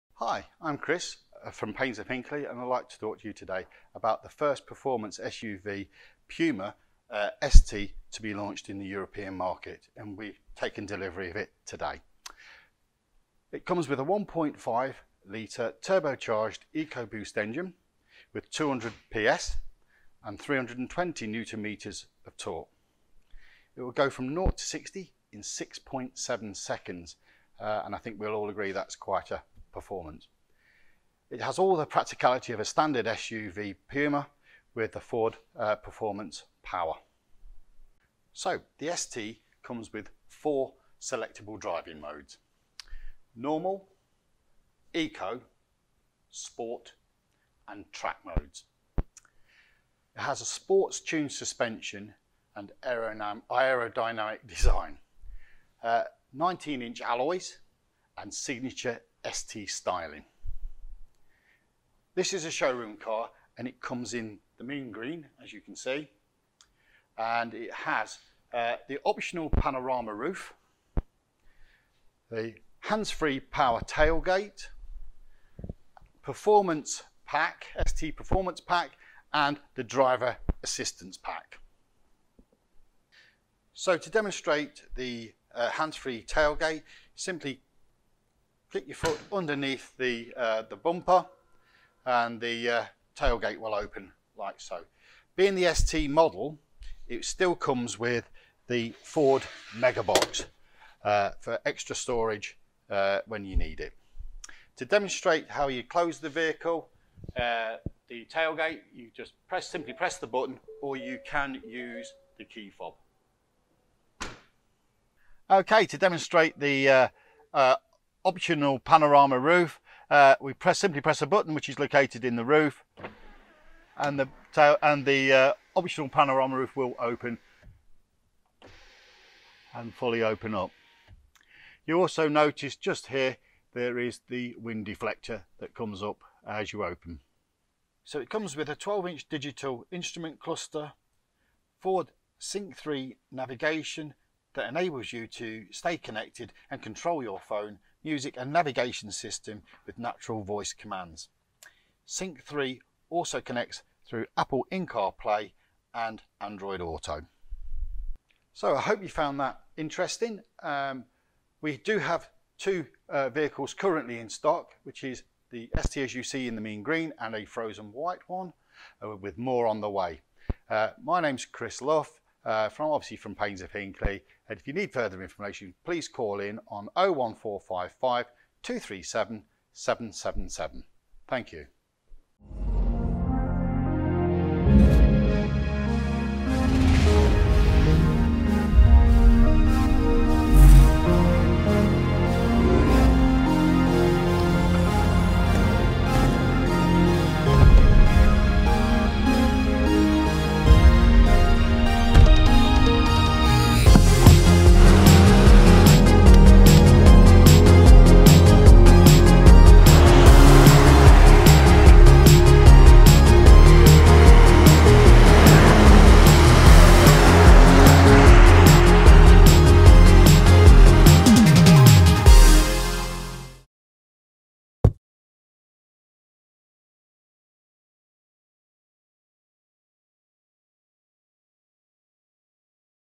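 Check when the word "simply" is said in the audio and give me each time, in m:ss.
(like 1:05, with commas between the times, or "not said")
1:27, 1:49, 2:00.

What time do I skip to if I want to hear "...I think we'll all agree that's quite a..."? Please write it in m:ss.
0:27.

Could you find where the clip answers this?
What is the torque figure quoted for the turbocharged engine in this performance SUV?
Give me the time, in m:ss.
0:20.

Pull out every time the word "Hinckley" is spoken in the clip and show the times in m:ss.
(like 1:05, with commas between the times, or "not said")
0:02, 2:53.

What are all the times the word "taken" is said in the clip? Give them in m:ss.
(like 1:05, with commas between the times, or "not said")
0:10.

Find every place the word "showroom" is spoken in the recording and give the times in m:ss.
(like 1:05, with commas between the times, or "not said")
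1:02.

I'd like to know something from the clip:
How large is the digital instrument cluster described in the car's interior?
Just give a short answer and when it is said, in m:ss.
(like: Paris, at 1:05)
12 inch, at 2:18.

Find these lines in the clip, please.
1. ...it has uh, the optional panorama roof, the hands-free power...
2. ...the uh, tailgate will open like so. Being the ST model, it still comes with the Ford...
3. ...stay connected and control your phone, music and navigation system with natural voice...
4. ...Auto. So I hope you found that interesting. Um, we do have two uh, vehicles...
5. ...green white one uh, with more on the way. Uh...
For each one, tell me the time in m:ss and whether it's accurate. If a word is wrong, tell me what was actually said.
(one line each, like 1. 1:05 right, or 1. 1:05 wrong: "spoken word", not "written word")
1. 1:07 right
2. 1:32 right
3. 2:25 right
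4. 2:36 right
5. 2:47 wrong: "frozen", not "green".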